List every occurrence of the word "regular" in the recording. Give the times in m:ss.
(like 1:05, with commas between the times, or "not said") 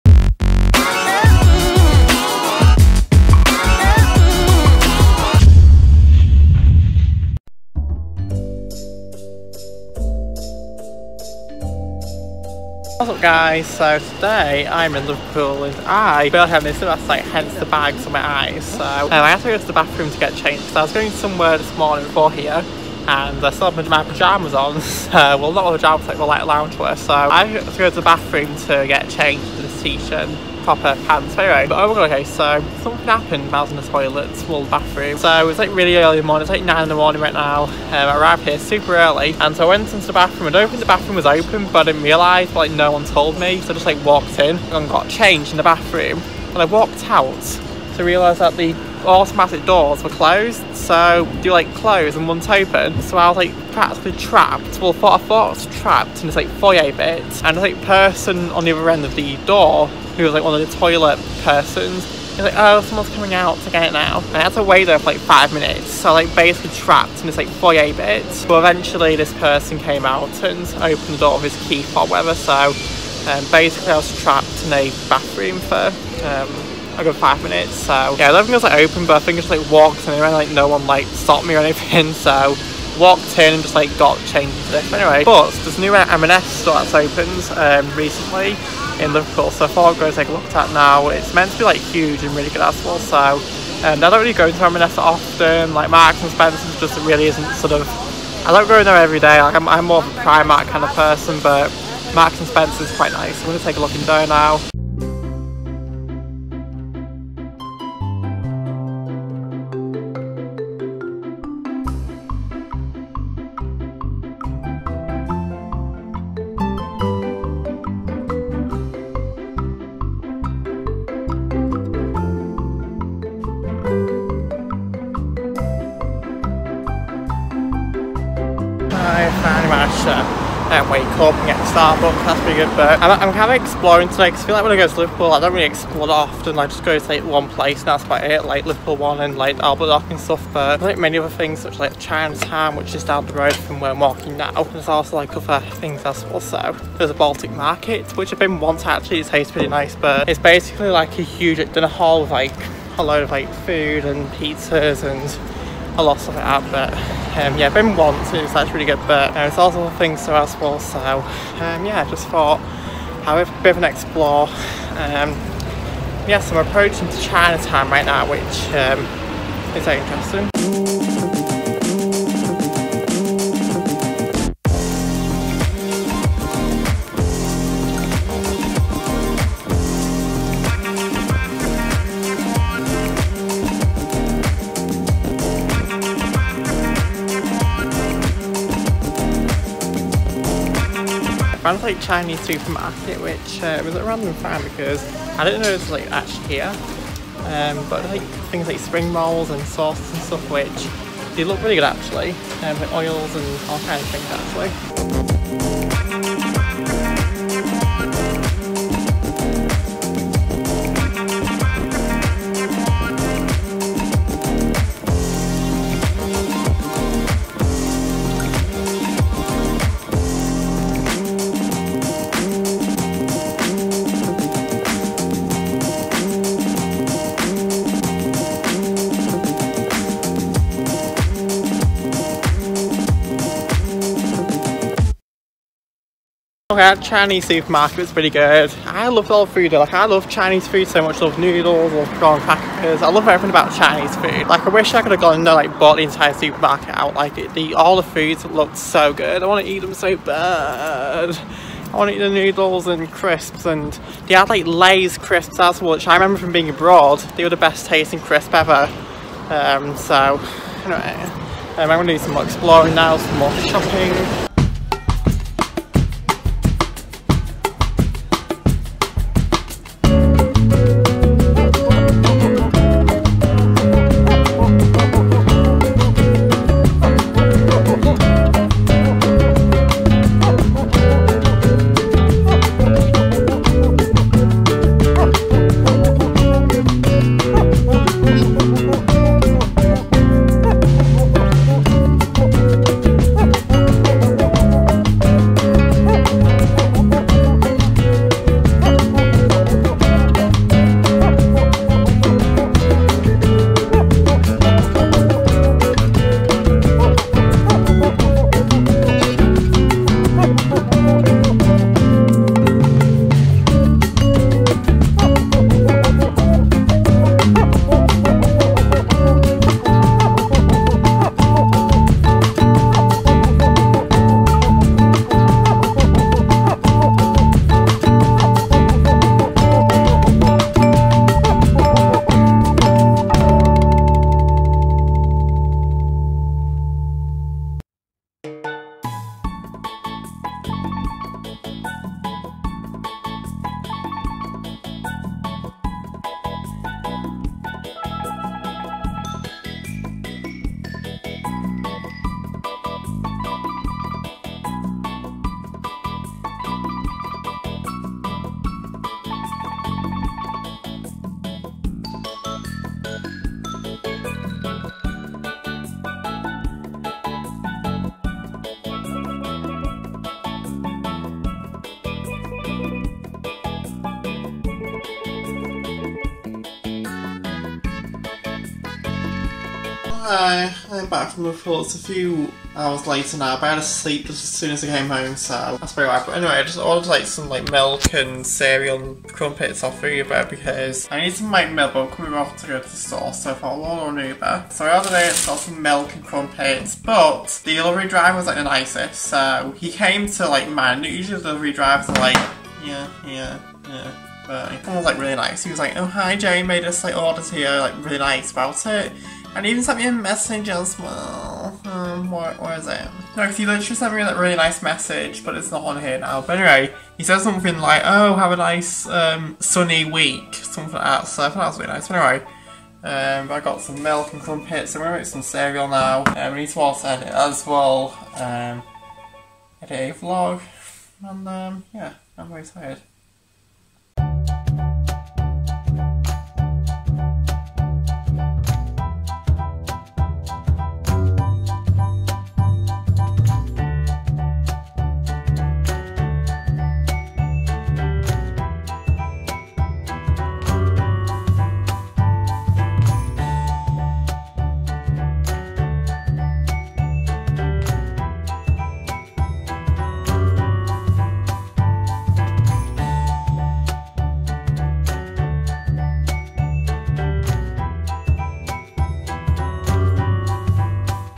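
not said.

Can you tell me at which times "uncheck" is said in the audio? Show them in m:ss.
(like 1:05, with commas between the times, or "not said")
not said.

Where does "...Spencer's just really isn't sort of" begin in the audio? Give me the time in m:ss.
1:36.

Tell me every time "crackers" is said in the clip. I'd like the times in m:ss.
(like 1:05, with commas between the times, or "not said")
4:02.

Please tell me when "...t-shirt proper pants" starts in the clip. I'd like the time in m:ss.
0:29.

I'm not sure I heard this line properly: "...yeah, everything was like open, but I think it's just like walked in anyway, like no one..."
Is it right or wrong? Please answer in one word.
right.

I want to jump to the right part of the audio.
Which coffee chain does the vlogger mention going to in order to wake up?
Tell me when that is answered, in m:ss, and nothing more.
2:11.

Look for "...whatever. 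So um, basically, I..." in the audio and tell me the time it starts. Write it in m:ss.
1:12.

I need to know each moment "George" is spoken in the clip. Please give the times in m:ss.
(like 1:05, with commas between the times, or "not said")
not said.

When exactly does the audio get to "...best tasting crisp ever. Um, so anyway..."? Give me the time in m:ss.
4:17.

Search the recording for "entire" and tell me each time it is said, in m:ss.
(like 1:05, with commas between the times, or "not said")
4:06.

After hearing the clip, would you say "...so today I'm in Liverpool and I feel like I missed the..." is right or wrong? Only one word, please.
right.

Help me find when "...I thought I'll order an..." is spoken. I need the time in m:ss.
6:33.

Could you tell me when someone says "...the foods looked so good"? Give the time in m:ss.
4:07.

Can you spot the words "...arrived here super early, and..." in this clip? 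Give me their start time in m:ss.
0:38.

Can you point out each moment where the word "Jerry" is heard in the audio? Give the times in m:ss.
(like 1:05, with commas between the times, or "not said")
6:46.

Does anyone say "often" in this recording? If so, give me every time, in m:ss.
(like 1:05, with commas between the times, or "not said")
1:34, 2:16.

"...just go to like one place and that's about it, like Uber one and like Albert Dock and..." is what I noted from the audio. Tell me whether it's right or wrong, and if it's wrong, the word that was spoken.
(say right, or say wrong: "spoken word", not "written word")
wrong: "Liverpool", not "Uber".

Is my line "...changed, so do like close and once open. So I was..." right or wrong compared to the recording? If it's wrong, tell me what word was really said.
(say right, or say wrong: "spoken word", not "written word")
wrong: "closed", not "changed".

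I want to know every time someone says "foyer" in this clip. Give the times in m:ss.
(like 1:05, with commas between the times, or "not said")
0:56, 1:07.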